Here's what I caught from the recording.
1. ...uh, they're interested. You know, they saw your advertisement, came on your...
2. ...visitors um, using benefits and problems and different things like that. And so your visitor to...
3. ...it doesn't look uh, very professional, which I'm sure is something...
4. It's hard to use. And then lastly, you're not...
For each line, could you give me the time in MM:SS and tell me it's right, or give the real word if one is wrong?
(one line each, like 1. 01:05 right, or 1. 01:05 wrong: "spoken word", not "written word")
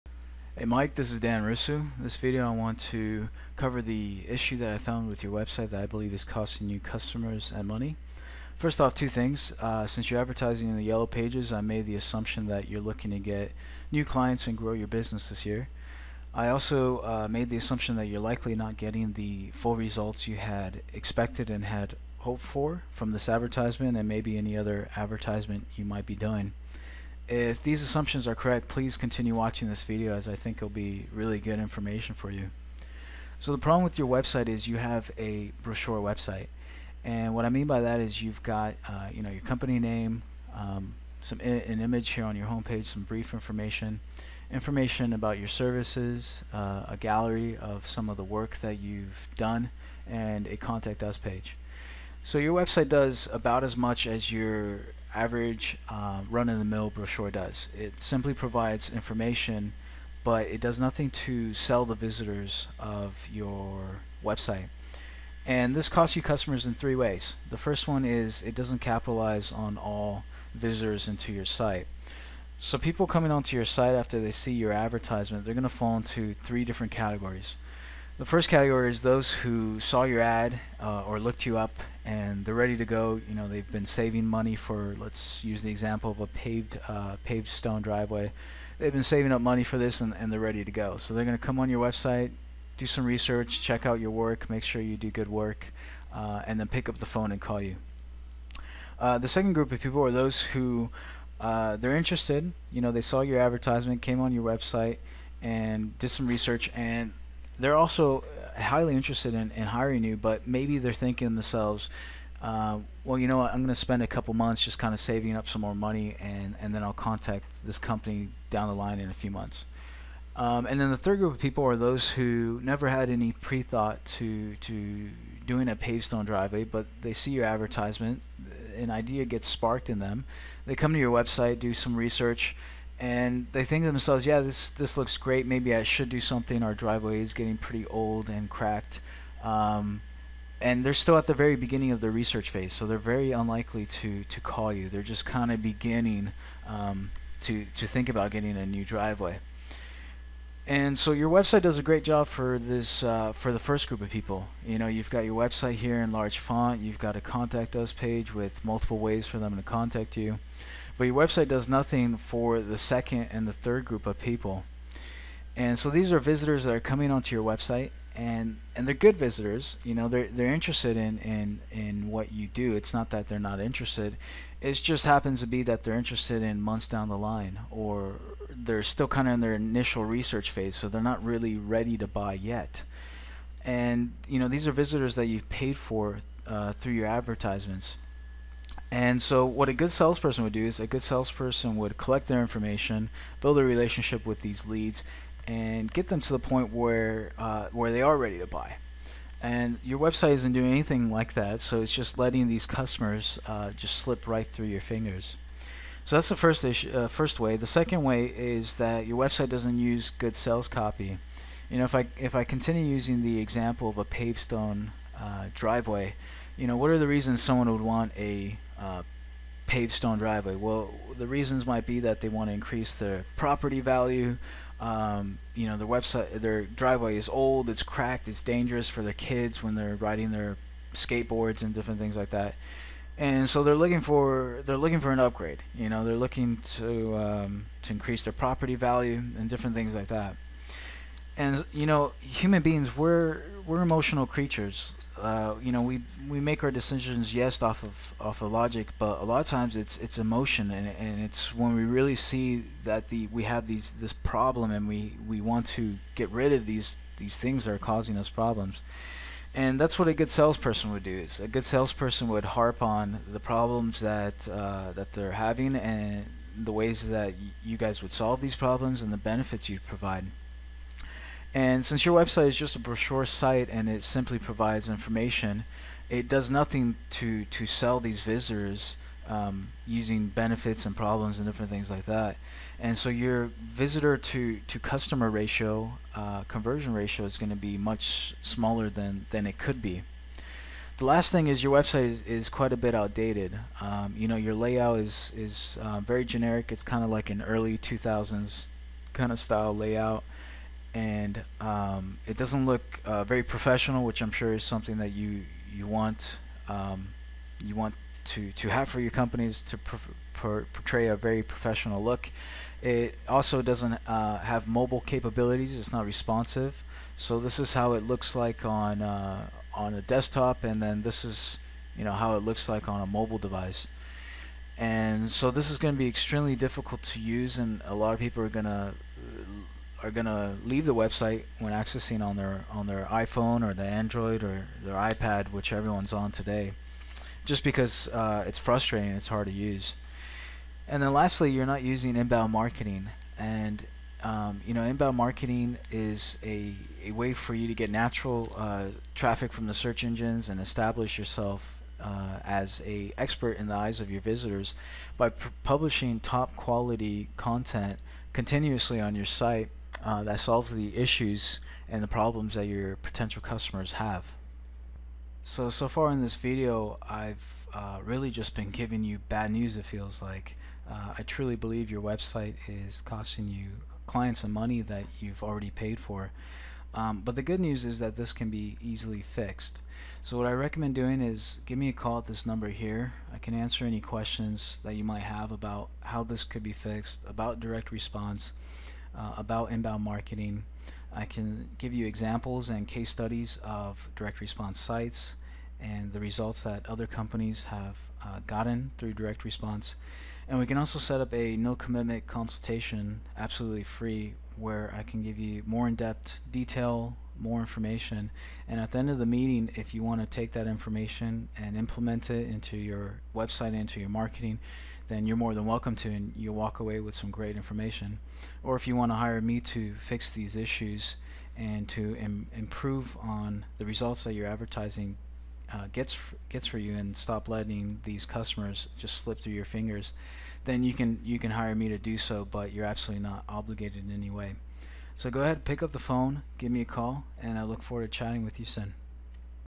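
1. 01:41 right
2. 04:38 right
3. 05:02 right
4. 05:39 right.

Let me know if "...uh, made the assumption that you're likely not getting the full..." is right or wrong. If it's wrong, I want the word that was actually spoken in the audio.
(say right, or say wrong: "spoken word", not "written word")
right.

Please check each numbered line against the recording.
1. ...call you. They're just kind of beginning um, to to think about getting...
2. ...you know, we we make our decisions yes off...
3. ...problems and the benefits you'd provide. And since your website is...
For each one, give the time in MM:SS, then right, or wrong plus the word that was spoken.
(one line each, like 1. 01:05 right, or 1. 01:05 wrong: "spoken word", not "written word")
1. 02:24 right
2. 04:05 right
3. 04:28 right.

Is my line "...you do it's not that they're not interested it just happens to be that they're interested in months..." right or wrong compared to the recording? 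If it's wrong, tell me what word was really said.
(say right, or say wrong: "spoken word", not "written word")
right.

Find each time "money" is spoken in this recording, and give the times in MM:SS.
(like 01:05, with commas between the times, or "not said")
00:07, 01:24, 01:29, 01:55, 06:14.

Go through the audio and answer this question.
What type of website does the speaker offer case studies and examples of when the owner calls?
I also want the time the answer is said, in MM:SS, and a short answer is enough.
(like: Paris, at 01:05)
direct response sites, at 06:34.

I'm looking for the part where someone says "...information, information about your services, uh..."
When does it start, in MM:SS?
00:43.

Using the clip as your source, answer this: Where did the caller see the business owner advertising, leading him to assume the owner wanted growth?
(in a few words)
yellow pages.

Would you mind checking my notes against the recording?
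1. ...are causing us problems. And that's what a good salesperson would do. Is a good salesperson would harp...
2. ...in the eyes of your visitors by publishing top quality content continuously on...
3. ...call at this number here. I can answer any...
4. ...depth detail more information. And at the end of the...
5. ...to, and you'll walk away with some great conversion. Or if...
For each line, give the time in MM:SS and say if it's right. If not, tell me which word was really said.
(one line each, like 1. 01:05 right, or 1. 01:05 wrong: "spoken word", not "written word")
1. 04:17 right
2. 05:53 right
3. 06:21 right
4. 06:45 right
5. 06:55 wrong: "information", not "conversion".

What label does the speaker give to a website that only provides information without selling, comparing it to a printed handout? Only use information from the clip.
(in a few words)
brochure website.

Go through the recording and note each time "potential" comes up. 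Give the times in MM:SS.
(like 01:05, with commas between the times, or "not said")
06:02.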